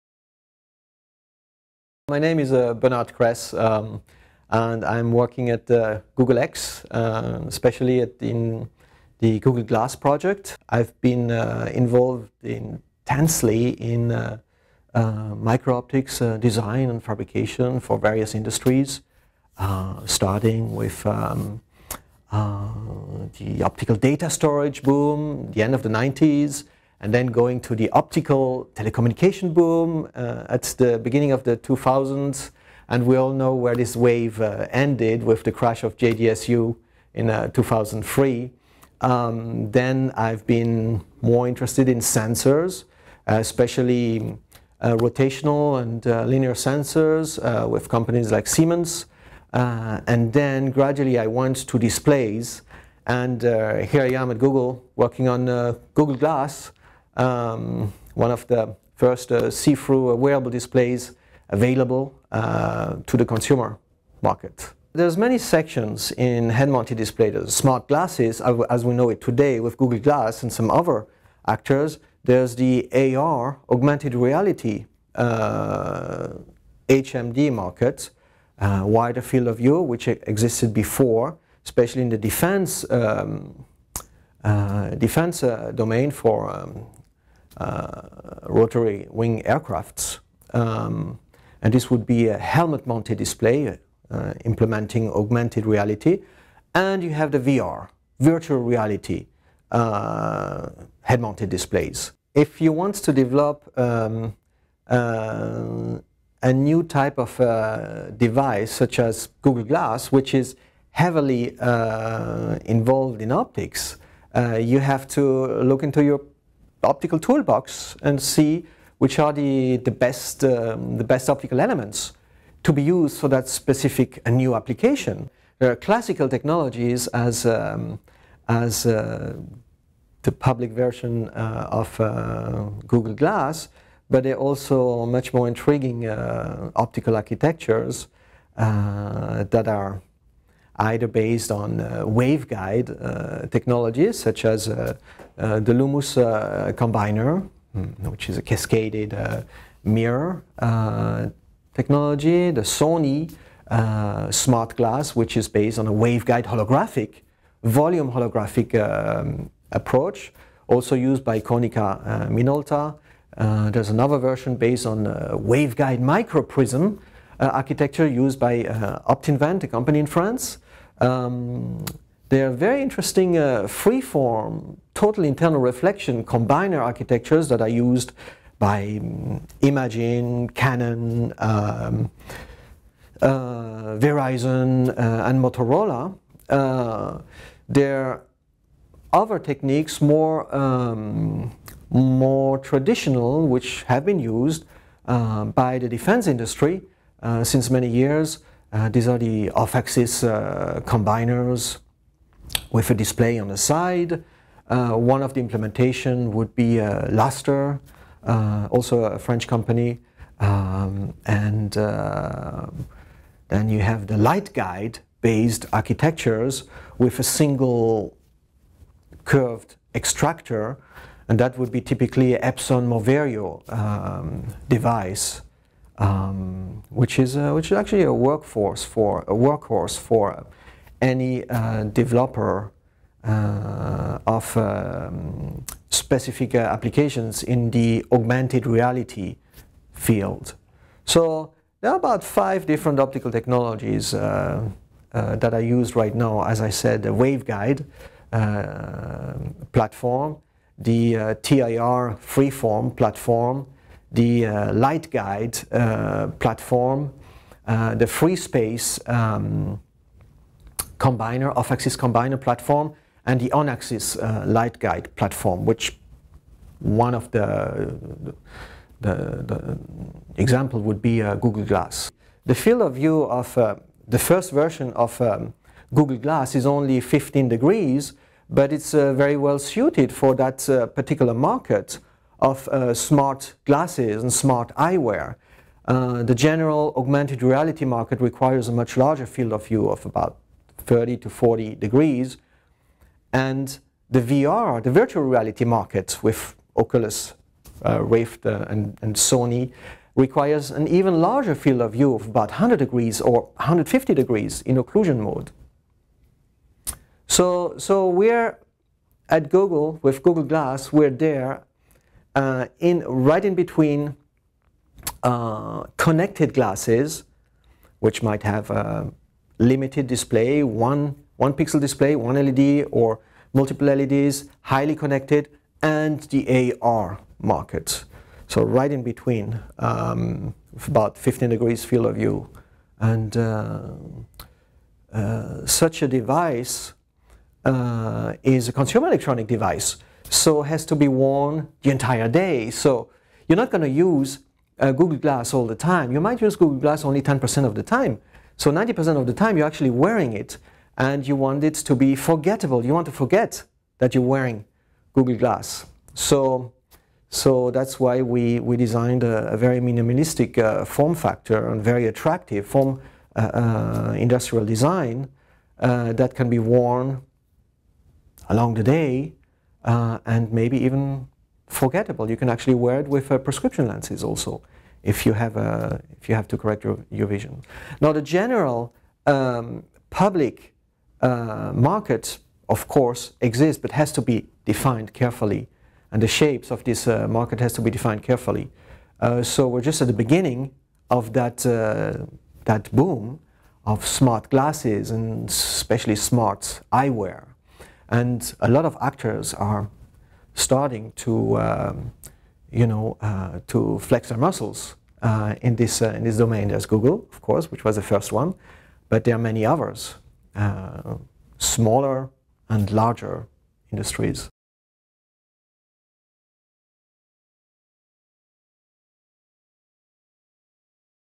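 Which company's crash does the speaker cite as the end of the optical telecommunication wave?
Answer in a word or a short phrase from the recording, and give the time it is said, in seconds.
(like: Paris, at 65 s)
JDSU, at 35 s.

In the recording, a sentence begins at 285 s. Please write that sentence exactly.
Uh, the general augmented reality market requires a much larger field of view of about 30 to 40 degrees.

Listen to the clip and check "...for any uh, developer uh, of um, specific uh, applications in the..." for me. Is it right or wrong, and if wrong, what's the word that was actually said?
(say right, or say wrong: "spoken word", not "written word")
right.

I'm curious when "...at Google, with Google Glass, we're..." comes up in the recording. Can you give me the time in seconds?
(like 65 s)
309 s.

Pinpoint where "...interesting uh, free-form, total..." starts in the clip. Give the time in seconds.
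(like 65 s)
172 s.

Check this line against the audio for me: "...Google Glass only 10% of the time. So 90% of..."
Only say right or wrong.
right.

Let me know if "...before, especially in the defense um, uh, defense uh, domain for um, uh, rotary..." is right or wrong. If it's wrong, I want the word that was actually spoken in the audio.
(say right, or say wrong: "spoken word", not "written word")
right.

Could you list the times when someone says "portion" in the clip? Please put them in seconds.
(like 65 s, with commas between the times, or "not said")
not said.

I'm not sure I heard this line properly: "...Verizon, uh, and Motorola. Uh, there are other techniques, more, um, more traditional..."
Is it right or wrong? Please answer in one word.
right.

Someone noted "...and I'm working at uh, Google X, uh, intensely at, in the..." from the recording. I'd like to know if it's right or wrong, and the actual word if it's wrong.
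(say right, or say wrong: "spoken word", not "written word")
wrong: "especially", not "intensely".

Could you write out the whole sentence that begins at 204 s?
Uh, one of the implementation would be Laster, also a French company.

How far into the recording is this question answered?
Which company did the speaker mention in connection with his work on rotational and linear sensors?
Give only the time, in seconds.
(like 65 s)
48 s.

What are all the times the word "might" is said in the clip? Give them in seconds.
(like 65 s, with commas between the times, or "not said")
318 s, 346 s.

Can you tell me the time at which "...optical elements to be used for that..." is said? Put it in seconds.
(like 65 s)
121 s.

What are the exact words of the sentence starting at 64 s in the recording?
There's many sections in head-mounted displays.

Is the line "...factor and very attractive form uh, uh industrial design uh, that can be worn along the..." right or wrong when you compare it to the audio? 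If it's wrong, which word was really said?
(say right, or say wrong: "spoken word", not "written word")
right.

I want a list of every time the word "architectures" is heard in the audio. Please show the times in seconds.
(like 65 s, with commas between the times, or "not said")
137 s, 167 s, 176 s, 215 s.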